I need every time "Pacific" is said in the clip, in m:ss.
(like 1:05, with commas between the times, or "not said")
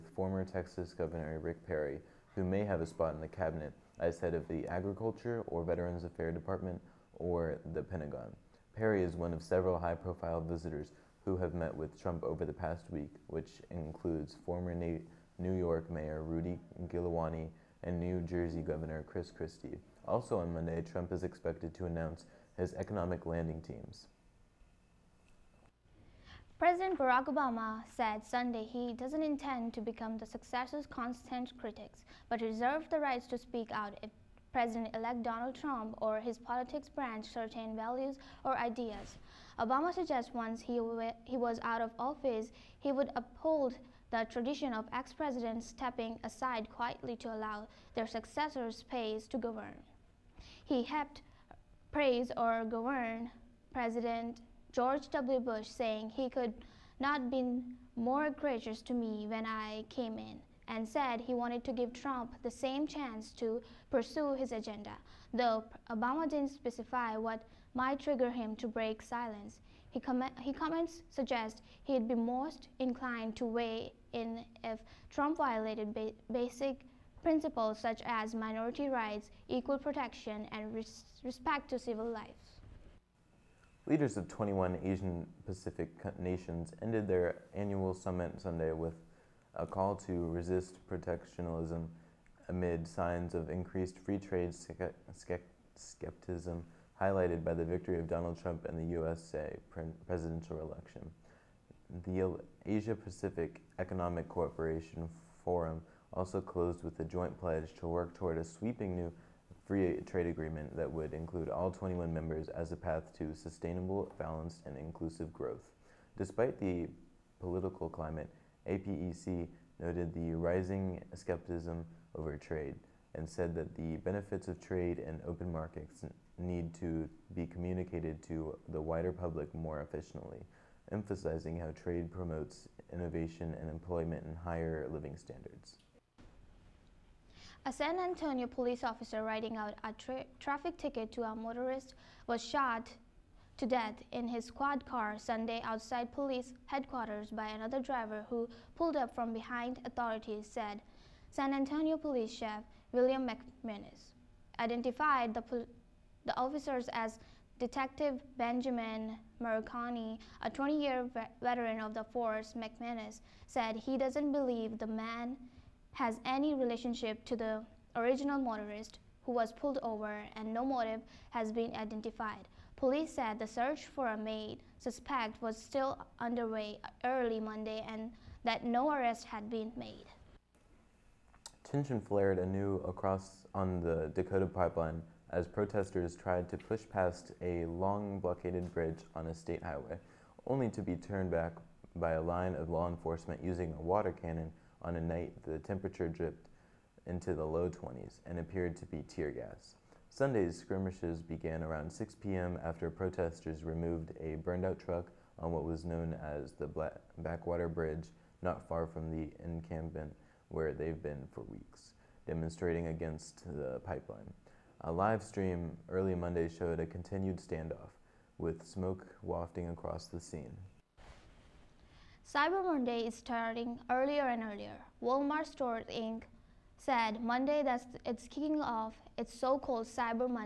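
1:25, 1:42.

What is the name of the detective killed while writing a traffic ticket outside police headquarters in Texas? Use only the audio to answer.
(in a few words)
Benjamin Marconi.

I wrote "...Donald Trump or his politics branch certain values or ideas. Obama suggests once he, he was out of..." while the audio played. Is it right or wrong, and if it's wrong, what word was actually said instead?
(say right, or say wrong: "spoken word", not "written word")
right.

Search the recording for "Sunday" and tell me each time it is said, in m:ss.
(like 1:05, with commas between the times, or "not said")
0:28, 1:28, 2:25, 3:20.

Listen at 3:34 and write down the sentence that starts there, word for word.
A live stream early Monday showed a continued standoff, with smoke wafting across the scene.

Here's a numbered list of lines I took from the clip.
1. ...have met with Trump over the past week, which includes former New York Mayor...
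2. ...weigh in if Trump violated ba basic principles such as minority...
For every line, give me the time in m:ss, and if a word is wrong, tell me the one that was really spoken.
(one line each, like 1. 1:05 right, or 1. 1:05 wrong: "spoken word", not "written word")
1. 0:11 right
2. 1:13 right.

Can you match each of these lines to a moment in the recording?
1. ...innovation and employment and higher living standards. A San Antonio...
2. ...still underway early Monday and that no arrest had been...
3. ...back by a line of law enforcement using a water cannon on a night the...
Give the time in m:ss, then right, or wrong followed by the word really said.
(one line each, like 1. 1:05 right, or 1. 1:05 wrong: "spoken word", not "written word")
1. 2:12 right
2. 2:55 right
3. 3:11 right.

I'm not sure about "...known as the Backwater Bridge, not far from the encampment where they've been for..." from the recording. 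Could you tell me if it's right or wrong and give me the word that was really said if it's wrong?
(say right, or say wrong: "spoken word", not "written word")
right.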